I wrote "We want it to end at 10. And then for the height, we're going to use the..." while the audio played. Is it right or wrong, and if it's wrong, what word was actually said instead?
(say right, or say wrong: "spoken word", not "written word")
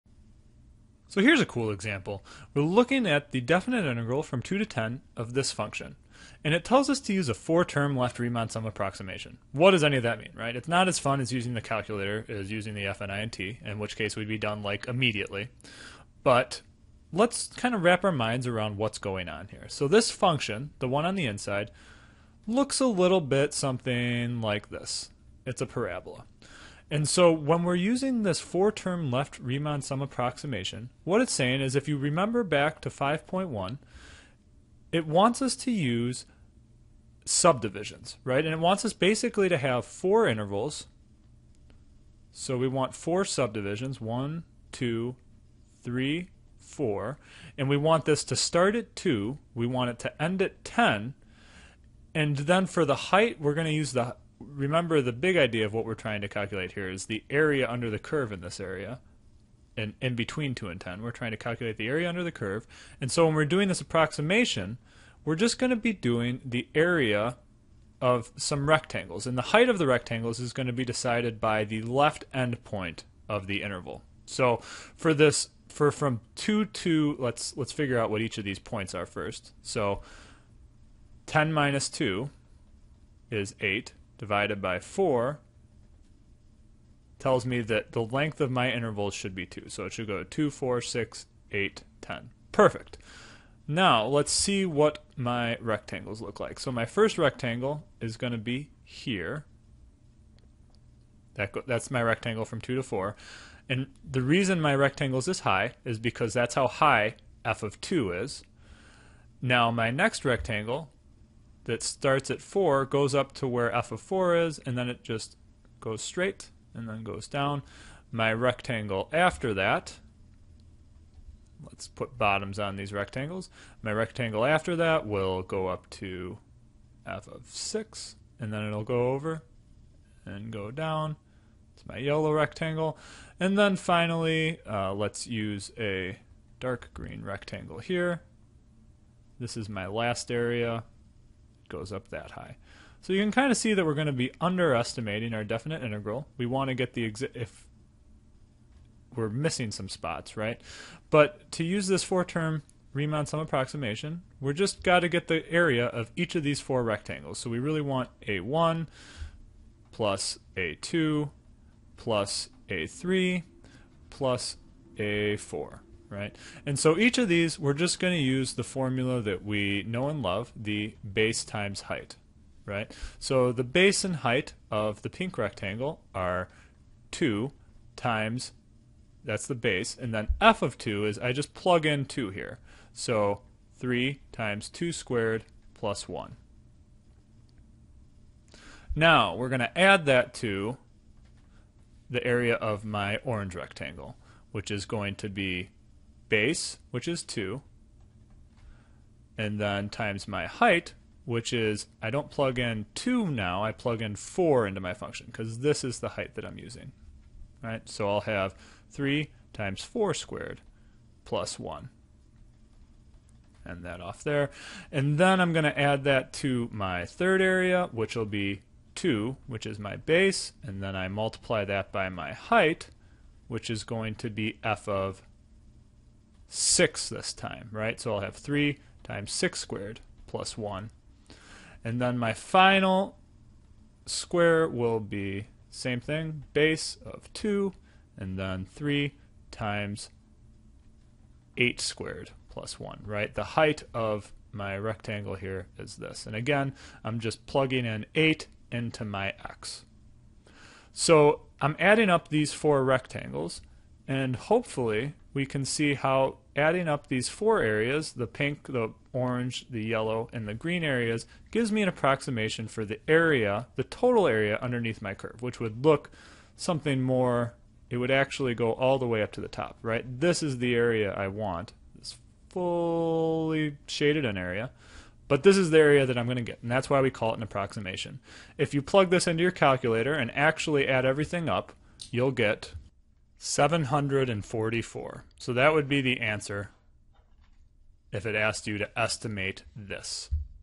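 right.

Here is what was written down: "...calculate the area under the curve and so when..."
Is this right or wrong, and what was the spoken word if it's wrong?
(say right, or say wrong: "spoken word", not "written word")
right.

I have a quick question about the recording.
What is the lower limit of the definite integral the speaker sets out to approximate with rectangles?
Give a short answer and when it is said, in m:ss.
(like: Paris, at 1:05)
2, at 0:04.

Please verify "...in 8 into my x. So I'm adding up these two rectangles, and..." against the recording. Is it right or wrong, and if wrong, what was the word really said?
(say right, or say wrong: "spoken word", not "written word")
wrong: "four", not "two".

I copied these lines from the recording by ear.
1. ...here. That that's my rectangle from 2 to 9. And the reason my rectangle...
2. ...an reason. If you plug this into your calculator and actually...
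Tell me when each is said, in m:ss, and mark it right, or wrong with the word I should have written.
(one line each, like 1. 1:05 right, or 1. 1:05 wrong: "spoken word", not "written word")
1. 1:38 wrong: "4", not "9"
2. 4:37 wrong: "approximation", not "reason".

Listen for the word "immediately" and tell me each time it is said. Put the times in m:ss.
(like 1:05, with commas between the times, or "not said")
0:14.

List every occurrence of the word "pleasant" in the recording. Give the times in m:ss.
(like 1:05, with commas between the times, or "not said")
not said.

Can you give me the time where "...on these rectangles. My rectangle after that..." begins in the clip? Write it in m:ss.
2:02.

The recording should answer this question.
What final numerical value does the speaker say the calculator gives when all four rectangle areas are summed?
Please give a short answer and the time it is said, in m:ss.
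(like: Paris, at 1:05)
744, at 4:43.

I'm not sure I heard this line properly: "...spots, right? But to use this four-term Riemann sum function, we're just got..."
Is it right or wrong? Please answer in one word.
wrong.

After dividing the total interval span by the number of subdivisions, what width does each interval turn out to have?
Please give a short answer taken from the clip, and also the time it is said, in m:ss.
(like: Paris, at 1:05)
2, at 1:28.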